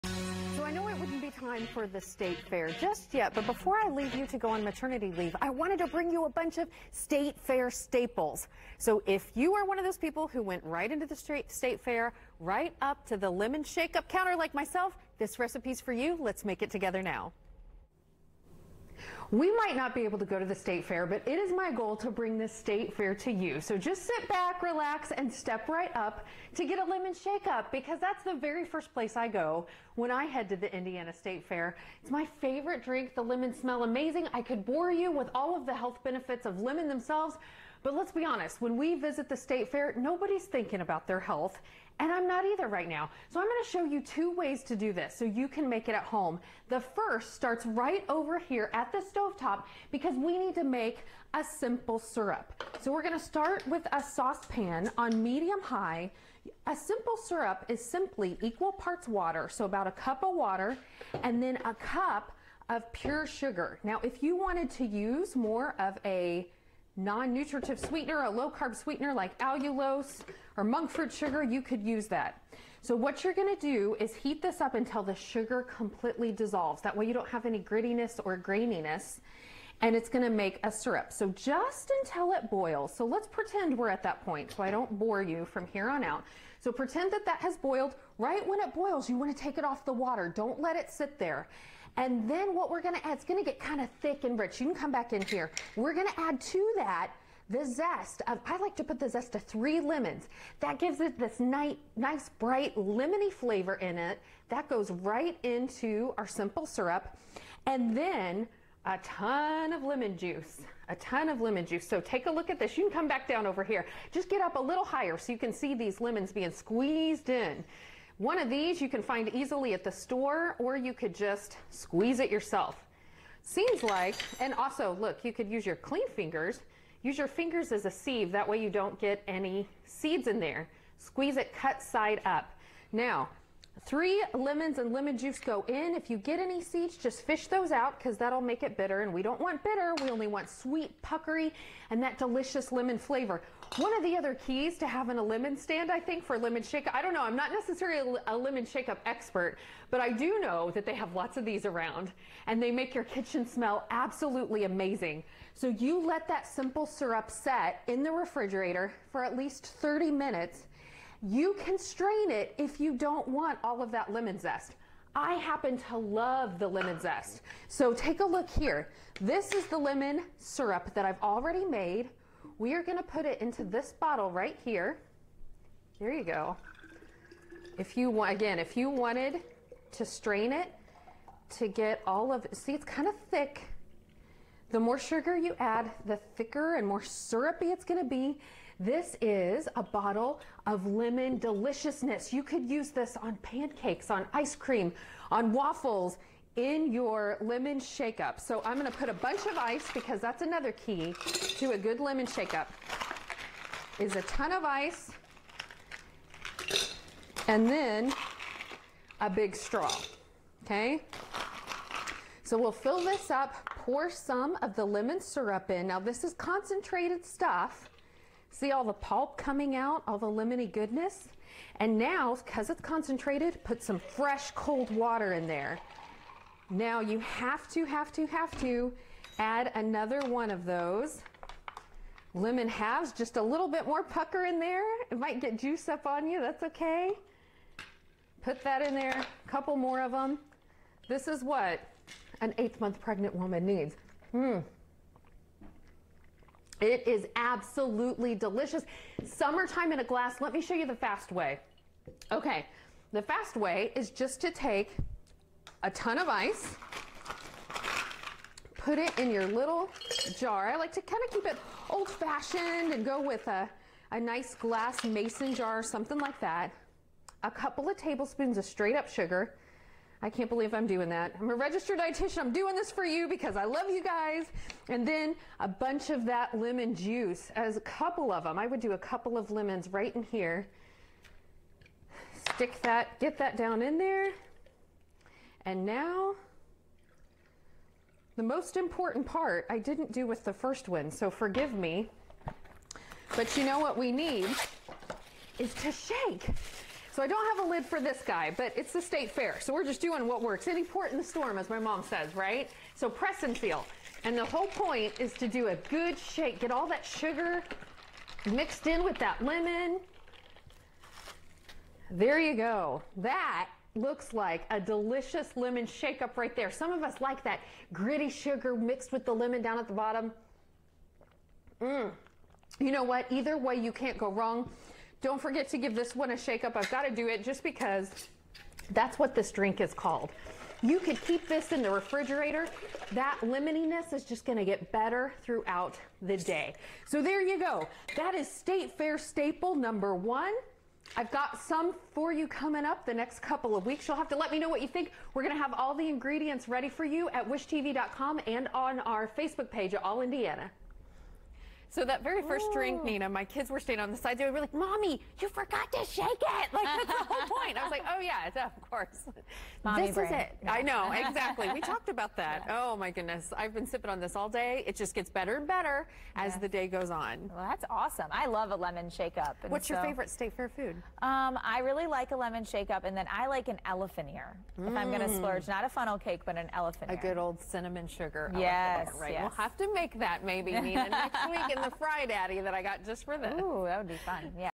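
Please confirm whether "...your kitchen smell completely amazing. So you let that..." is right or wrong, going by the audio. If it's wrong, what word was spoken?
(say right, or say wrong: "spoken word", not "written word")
wrong: "absolutely", not "completely".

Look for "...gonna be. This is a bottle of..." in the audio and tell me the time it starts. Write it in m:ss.
3:07.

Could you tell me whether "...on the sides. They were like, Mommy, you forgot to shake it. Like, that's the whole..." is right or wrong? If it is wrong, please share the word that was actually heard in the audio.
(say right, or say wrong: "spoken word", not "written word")
right.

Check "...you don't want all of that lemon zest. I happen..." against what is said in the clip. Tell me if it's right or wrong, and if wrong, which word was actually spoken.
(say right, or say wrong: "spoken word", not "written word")
right.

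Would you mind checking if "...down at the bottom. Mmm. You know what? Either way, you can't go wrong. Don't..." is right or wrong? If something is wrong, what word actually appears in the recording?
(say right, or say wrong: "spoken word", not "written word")
right.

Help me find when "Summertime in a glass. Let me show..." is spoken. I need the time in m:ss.
4:09.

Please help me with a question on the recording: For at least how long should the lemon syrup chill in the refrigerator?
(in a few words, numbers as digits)
30 minutes.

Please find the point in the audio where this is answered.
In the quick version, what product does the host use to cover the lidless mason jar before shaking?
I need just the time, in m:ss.
5:03.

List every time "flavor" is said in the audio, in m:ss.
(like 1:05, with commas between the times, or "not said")
1:43, 2:22.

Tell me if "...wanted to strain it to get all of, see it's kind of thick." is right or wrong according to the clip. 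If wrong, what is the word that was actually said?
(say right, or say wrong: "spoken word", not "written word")
right.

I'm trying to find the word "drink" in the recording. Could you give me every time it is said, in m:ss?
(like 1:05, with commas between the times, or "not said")
0:32, 5:29, 5:52.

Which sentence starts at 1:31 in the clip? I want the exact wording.
And then what we're gonna add, it's gonna get kind of thick and rich.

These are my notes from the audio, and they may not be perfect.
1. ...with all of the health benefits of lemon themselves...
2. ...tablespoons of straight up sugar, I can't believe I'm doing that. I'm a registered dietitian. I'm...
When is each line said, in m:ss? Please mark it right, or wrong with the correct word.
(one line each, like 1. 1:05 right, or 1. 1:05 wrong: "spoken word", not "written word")
1. 0:35 right
2. 4:27 right.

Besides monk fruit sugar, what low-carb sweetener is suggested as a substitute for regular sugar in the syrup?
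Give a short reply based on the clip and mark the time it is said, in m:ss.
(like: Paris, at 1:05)
allulose, at 1:09.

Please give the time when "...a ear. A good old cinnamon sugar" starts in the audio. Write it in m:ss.
6:17.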